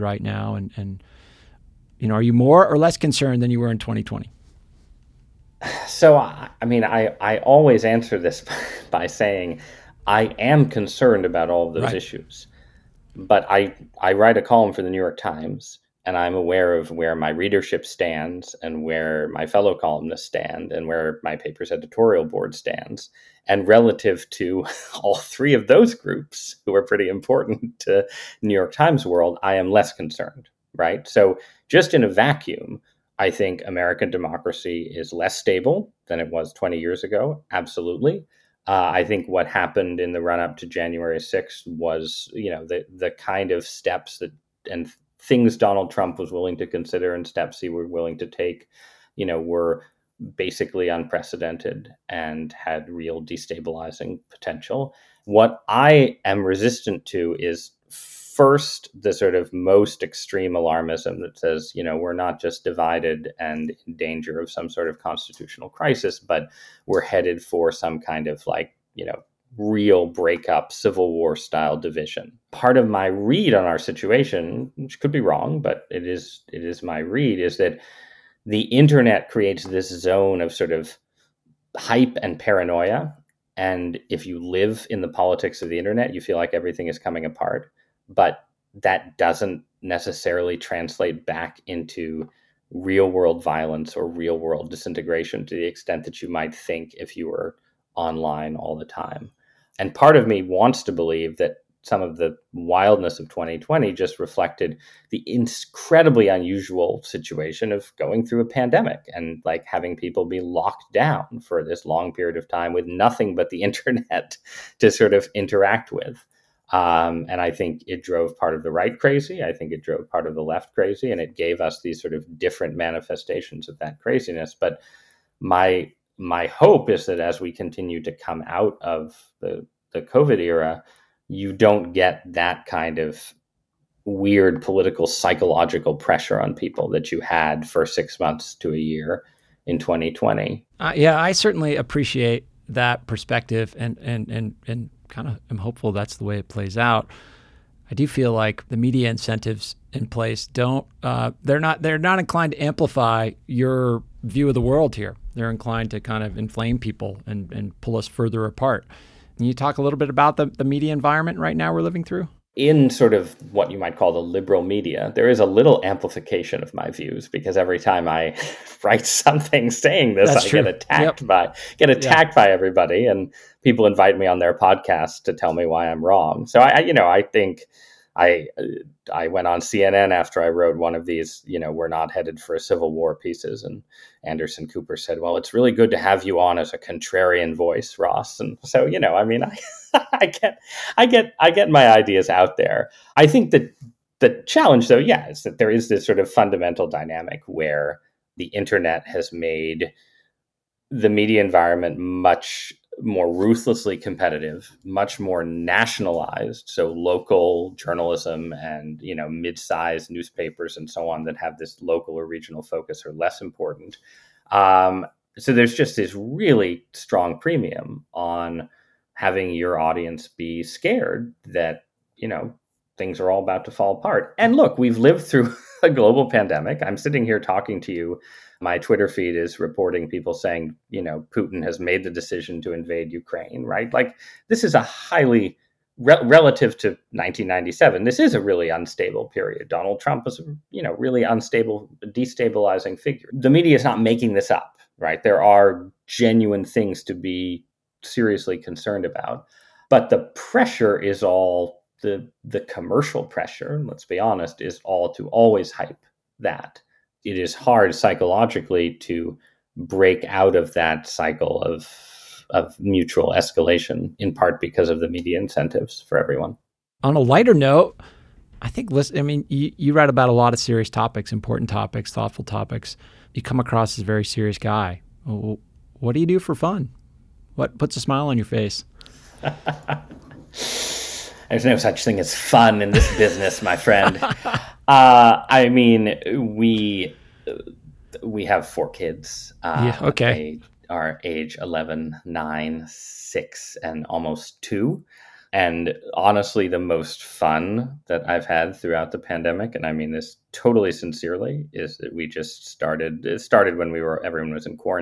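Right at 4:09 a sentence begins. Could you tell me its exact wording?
But the pressure is all the the commercial pressure, let's be honest, is all to always hype that.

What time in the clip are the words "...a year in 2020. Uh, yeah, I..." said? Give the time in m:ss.
2:18.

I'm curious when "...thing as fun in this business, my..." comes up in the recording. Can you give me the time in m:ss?
4:42.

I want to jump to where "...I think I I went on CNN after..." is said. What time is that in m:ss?
2:57.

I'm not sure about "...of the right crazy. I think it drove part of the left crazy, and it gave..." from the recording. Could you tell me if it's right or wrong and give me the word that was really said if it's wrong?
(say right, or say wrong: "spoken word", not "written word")
right.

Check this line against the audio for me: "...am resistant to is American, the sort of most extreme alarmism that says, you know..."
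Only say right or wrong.
wrong.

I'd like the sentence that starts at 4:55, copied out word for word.
And honestly, the most fun that I've had throughout the pandemic, and I mean this totally sincerely, is that we just started.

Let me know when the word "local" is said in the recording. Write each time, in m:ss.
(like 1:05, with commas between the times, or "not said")
3:26, 3:31.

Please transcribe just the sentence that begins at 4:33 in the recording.
You come across as a very serious guy.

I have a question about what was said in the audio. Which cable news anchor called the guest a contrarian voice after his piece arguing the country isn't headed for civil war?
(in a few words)
Anderson Cooper.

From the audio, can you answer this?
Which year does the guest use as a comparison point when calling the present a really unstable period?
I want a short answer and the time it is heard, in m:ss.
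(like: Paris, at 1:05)
1997, at 3:57.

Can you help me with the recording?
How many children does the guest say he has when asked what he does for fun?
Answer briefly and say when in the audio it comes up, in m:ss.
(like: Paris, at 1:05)
4, at 4:48.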